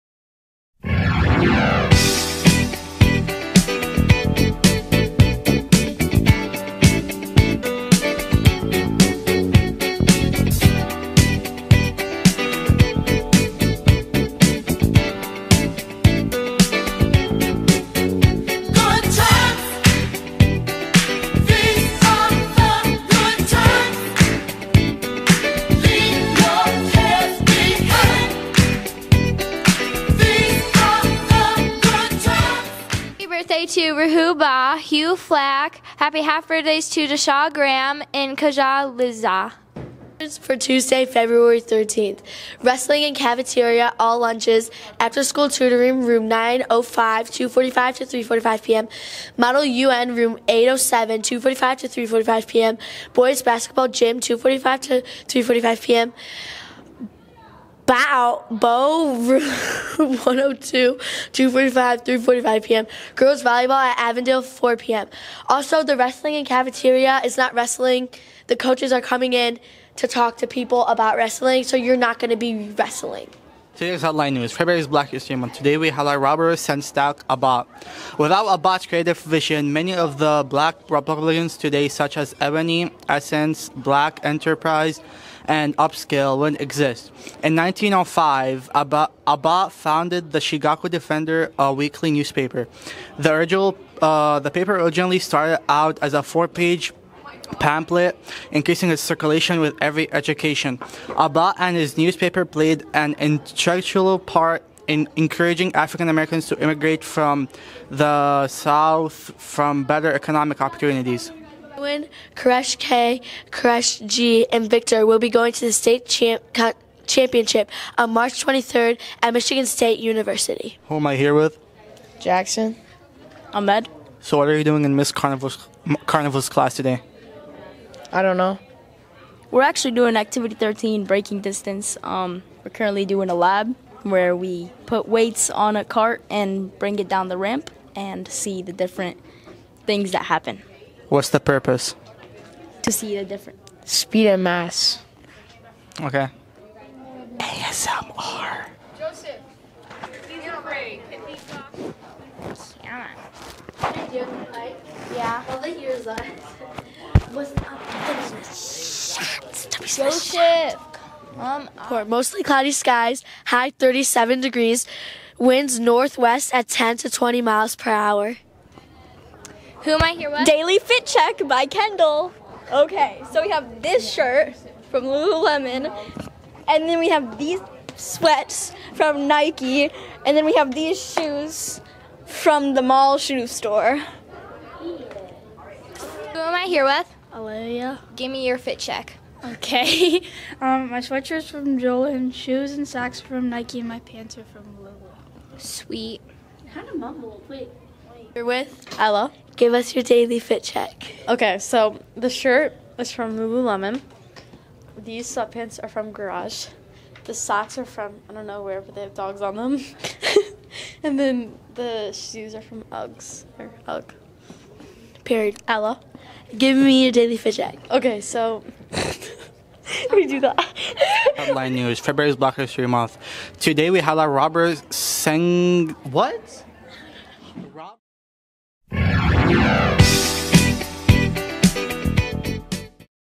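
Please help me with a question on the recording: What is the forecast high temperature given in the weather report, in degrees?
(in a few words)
37.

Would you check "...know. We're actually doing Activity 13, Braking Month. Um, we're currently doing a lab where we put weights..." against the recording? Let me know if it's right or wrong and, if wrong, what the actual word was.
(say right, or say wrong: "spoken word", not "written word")
wrong: "Distance", not "Month".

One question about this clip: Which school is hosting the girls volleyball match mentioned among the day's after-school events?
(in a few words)
Avondale.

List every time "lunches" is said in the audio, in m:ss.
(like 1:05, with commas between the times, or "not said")
0:44.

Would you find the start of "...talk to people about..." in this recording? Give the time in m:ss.
1:10.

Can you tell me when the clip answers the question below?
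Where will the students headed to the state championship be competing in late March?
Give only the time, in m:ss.
1:59.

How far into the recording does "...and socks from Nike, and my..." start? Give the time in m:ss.
3:12.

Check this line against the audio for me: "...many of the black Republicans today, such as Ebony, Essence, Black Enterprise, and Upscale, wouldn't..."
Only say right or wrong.
right.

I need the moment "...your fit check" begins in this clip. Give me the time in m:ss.
3:08.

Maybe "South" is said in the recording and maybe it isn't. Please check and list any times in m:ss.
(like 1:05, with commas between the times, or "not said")
1:48.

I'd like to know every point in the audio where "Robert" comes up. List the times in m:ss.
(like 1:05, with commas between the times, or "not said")
1:16.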